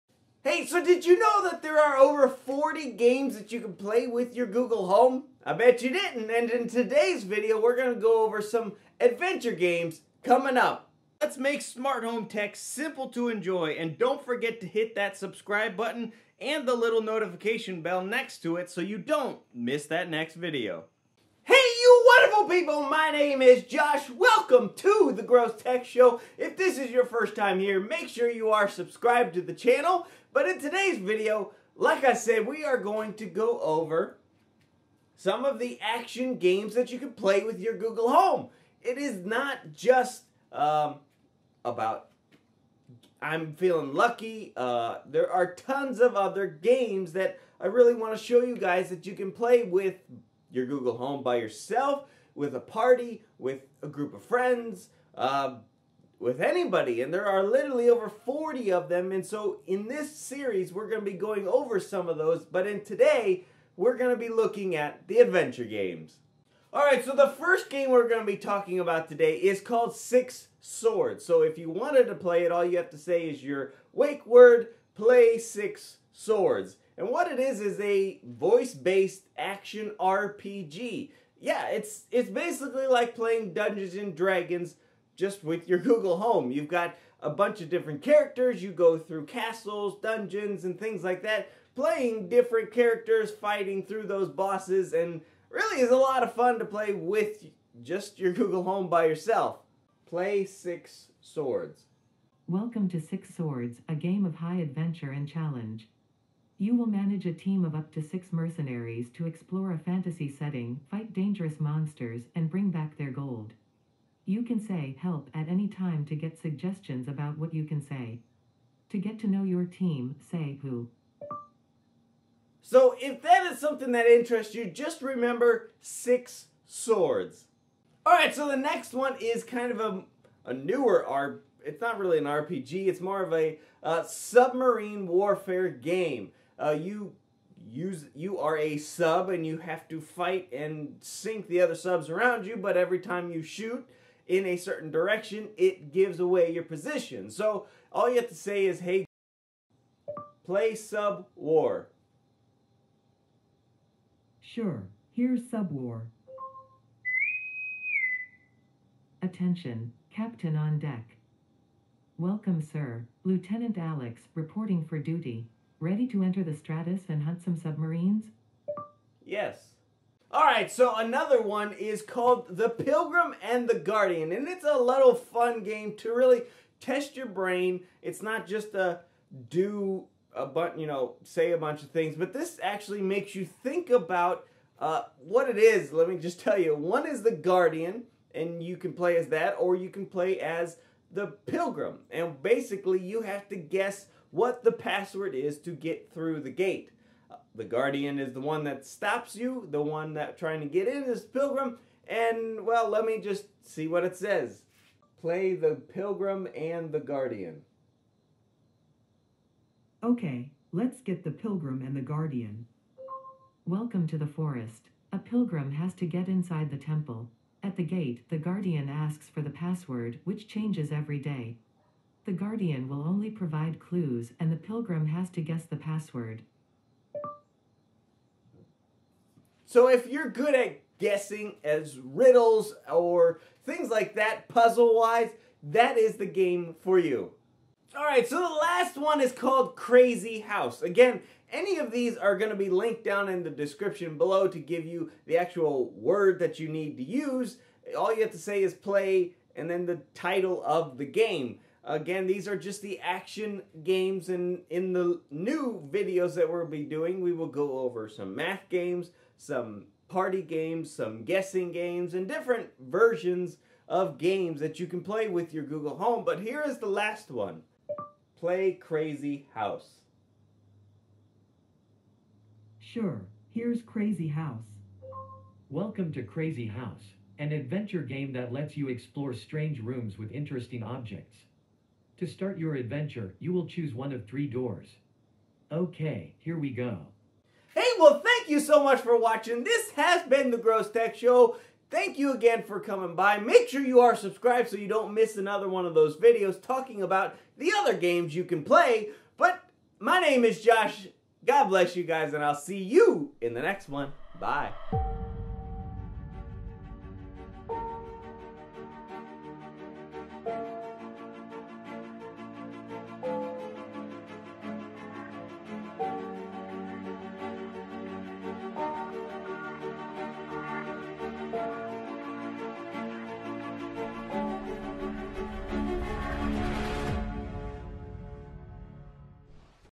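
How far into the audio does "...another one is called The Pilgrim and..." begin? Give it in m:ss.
2:50.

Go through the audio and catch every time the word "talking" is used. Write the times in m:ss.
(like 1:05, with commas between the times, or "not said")
1:08, 4:56.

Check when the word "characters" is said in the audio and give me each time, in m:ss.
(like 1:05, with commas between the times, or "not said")
1:28, 1:32.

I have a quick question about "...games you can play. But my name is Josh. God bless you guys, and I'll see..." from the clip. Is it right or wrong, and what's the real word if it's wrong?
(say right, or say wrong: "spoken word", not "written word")
right.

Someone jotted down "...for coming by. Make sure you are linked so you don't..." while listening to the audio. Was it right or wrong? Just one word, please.
wrong.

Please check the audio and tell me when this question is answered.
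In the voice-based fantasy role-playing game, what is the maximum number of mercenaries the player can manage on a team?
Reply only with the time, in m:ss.
1:47.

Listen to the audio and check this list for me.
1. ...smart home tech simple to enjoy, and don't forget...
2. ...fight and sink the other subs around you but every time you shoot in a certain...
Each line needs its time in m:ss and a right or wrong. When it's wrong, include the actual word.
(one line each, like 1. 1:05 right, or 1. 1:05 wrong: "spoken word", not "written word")
1. 0:11 right
2. 2:20 right.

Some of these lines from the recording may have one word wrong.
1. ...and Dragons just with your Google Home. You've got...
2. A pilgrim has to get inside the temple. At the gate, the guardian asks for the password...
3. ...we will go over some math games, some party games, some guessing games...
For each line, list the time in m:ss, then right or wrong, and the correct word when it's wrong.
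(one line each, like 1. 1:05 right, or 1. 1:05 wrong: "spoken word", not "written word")
1. 1:23 right
2. 3:35 right
3. 4:17 right.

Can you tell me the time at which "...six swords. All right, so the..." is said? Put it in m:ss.
2:05.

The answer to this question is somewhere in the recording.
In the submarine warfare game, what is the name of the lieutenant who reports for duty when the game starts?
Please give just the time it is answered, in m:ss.
2:43.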